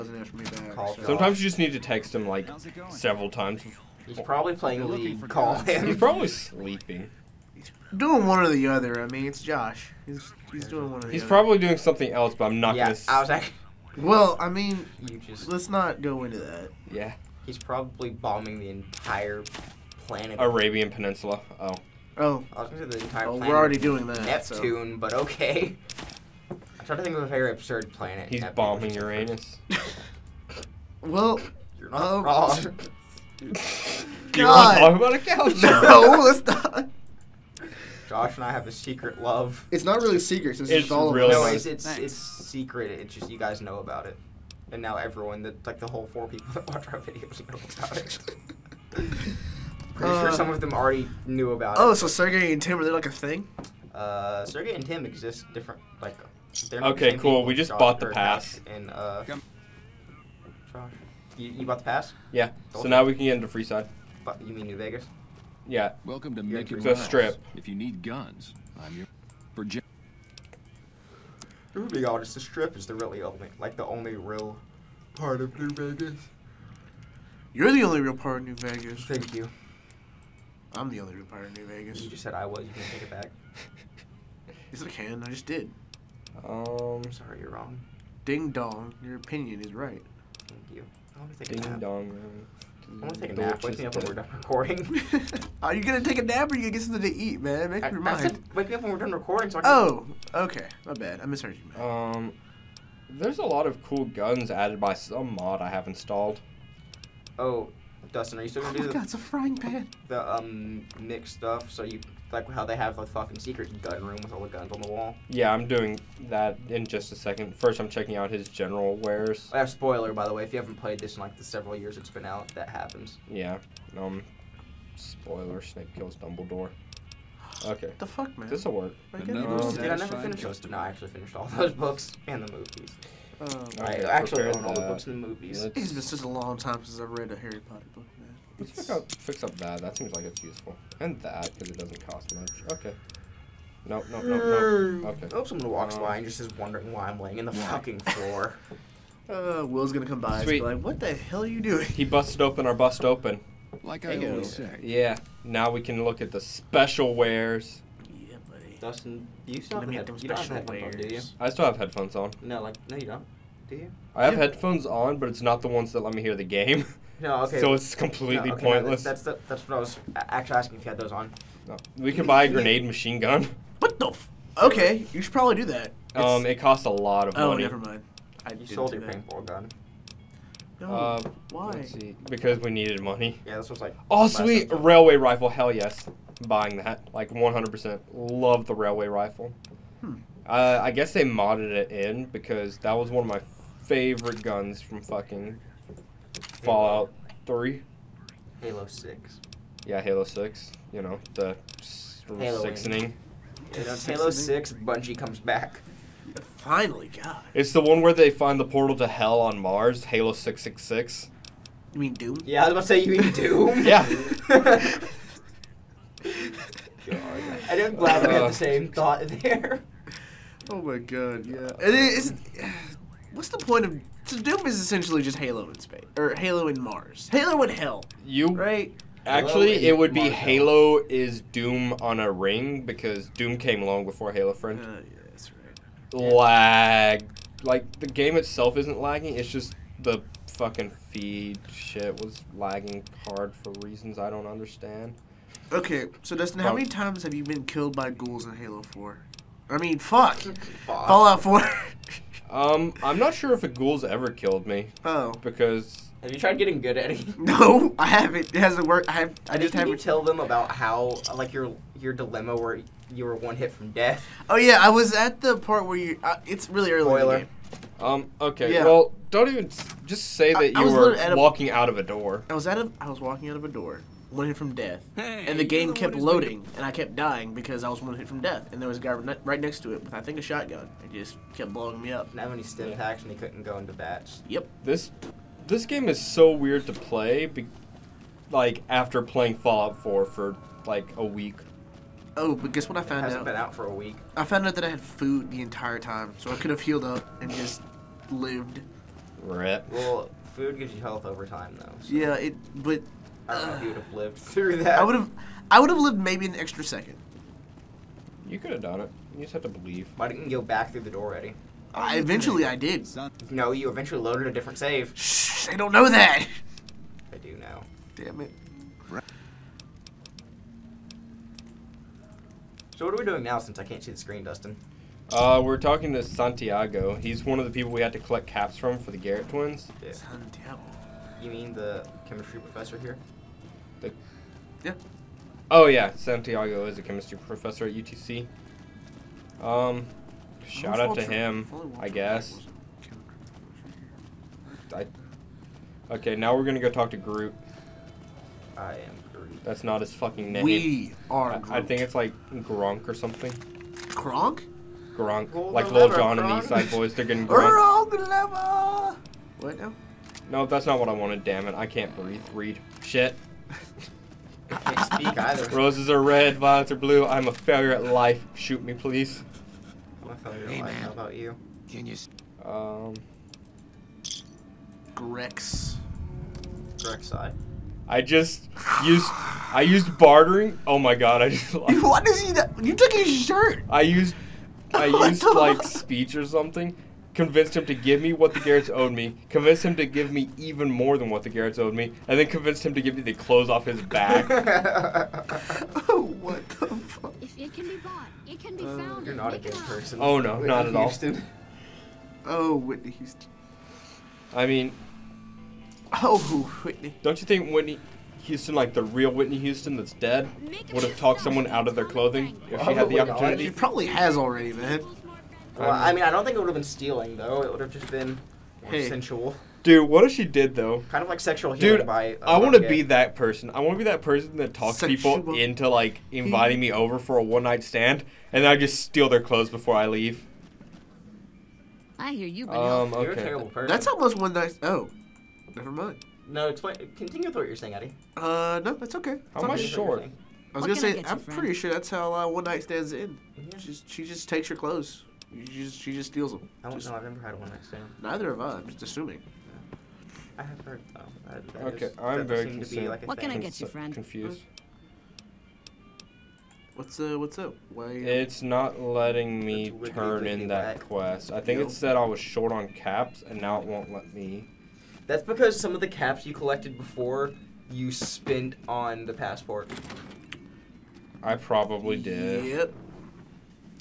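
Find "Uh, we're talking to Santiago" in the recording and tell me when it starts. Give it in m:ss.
5:25.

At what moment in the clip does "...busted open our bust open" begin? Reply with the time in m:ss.
2:32.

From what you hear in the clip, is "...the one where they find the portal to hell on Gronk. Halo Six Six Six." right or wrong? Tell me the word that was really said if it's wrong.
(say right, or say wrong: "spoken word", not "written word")
wrong: "Mars", not "Gronk".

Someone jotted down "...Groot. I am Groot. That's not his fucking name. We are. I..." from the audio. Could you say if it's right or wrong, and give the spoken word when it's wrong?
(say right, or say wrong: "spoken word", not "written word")
right.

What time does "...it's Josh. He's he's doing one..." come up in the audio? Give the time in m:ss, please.
0:09.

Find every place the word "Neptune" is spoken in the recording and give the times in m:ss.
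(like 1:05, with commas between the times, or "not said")
0:24, 0:28.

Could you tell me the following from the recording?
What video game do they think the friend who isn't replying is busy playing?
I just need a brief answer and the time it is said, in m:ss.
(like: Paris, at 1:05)
League, at 0:04.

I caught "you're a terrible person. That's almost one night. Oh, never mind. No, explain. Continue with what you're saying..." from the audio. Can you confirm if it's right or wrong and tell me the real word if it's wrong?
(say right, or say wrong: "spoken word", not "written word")
right.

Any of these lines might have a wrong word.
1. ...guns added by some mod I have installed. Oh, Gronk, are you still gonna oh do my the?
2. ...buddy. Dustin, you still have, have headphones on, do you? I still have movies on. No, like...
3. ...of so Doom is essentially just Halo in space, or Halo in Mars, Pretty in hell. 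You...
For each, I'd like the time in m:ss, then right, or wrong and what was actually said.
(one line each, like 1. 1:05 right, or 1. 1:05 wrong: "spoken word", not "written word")
1. 1:44 wrong: "Dustin", not "Gronk"
2. 2:38 wrong: "headphones", not "movies"
3. 3:43 wrong: "Halo", not "Pretty".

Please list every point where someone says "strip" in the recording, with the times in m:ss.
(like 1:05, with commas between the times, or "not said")
1:06, 1:12.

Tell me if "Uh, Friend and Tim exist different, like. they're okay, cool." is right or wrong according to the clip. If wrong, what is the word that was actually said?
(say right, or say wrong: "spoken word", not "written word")
wrong: "Sergey", not "Friend".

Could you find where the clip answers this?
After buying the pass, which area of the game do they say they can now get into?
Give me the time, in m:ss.
1:03.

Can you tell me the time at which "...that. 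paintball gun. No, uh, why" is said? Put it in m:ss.
2:59.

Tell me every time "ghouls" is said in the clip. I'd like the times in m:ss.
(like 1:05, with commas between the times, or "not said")
4:08, 4:13.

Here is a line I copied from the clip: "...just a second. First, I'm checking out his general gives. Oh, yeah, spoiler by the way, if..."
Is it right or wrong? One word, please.
wrong.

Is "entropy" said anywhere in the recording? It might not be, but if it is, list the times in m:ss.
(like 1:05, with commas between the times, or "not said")
not said.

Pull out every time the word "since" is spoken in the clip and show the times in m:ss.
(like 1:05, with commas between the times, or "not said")
2:16, 5:23.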